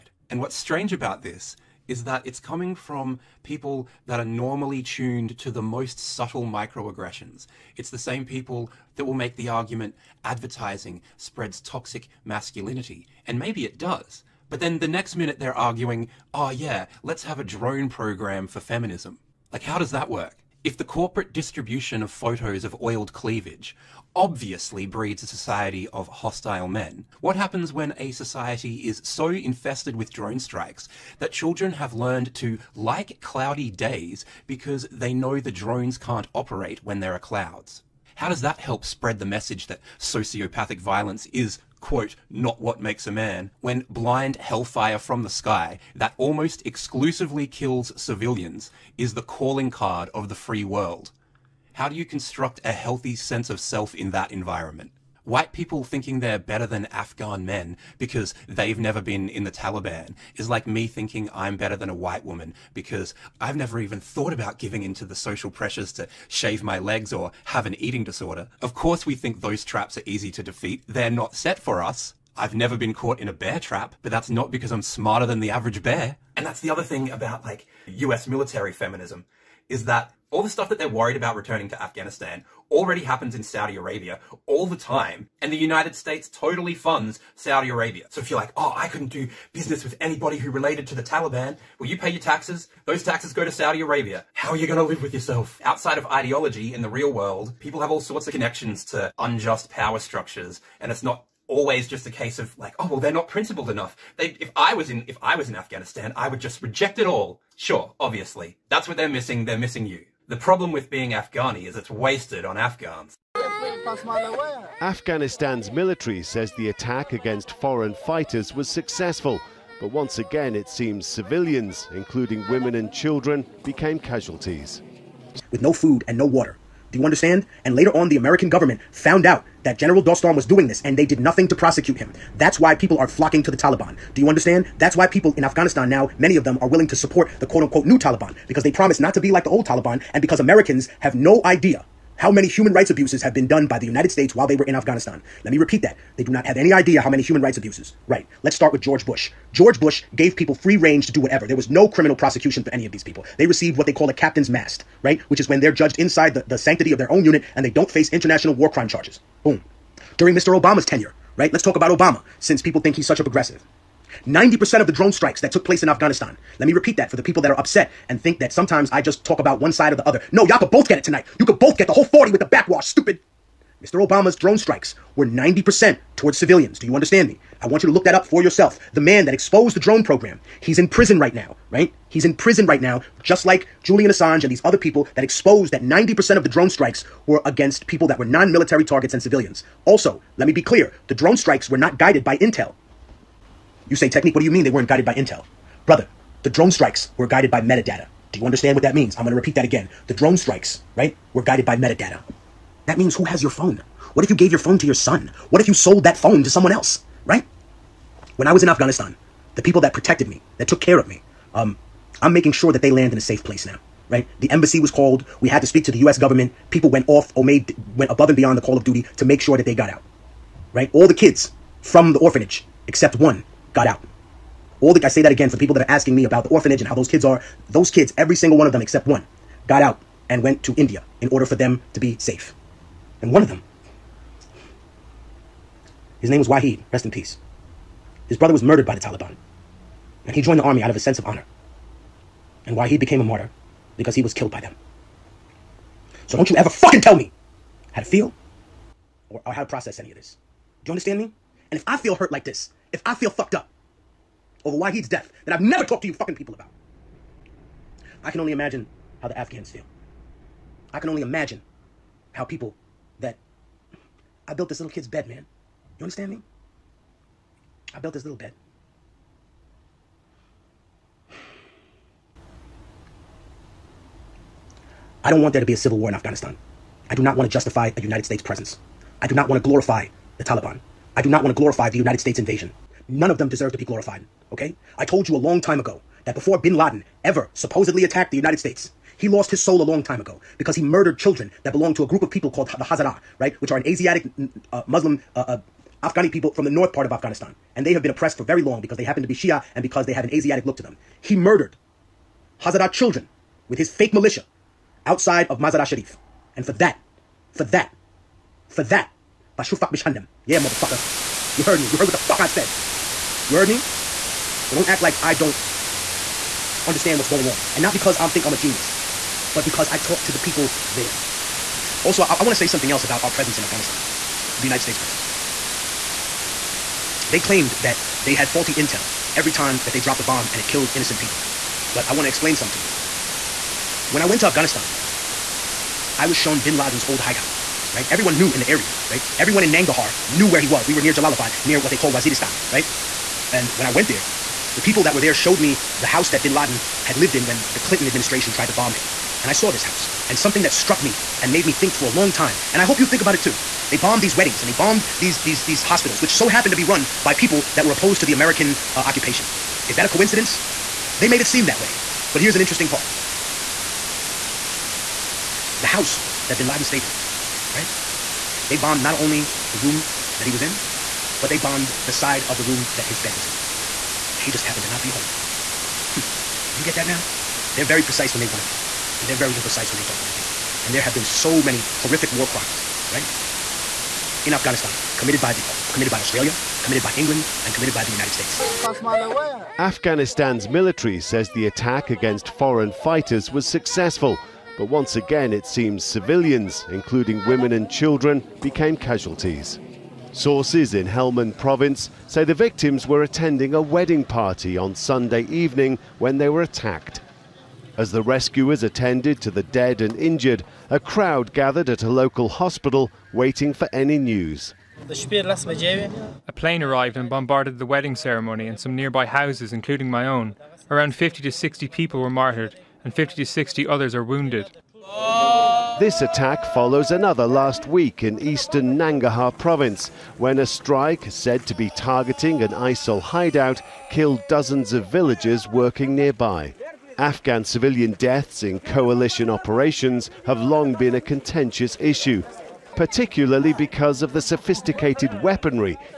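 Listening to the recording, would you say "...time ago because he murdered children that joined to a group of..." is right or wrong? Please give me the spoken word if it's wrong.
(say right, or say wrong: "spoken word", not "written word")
wrong: "belonged", not "joined".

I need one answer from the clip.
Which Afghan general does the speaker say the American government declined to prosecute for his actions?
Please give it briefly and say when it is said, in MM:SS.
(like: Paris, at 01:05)
General Dostum, at 02:09.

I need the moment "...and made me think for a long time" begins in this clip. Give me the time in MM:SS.
05:51.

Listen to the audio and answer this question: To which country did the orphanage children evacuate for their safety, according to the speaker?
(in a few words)
India.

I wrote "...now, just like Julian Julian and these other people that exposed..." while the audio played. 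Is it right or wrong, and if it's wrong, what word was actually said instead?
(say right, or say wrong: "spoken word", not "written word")
wrong: "Assange", not "Julian".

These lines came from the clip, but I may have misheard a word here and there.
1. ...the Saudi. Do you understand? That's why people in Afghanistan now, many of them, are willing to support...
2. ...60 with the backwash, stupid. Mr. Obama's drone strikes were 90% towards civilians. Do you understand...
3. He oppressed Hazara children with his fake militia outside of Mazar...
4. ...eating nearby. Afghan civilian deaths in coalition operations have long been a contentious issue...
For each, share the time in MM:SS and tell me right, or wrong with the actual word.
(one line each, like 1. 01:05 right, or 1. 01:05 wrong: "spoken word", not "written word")
1. 02:13 wrong: "Taliban", not "Saudi"
2. 02:52 wrong: "40", not "60"
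3. 05:01 wrong: "murdered", not "oppressed"
4. 07:15 wrong: "working", not "eating".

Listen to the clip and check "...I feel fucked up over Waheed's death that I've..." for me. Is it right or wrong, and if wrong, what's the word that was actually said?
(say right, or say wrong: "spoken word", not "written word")
right.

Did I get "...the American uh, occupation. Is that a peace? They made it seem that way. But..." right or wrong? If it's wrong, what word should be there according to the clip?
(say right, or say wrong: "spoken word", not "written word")
wrong: "coincidence", not "peace".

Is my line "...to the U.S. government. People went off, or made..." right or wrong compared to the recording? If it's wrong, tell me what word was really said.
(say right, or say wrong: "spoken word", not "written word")
right.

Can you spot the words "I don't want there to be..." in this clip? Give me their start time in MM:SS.
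04:35.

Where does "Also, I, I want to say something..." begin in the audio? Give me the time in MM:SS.
05:22.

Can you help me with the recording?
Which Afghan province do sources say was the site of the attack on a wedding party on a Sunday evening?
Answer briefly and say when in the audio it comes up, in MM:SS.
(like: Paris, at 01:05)
Helmand, at 06:41.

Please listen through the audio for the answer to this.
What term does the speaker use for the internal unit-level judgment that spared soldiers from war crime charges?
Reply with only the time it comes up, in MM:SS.
02:34.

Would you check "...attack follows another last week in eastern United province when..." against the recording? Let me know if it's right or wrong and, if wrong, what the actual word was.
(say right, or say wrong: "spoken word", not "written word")
wrong: "Nangarhar", not "United".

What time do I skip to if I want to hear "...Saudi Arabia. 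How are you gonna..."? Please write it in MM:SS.
01:33.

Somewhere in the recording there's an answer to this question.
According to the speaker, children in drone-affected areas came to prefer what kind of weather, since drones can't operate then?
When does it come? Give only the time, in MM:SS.
00:33.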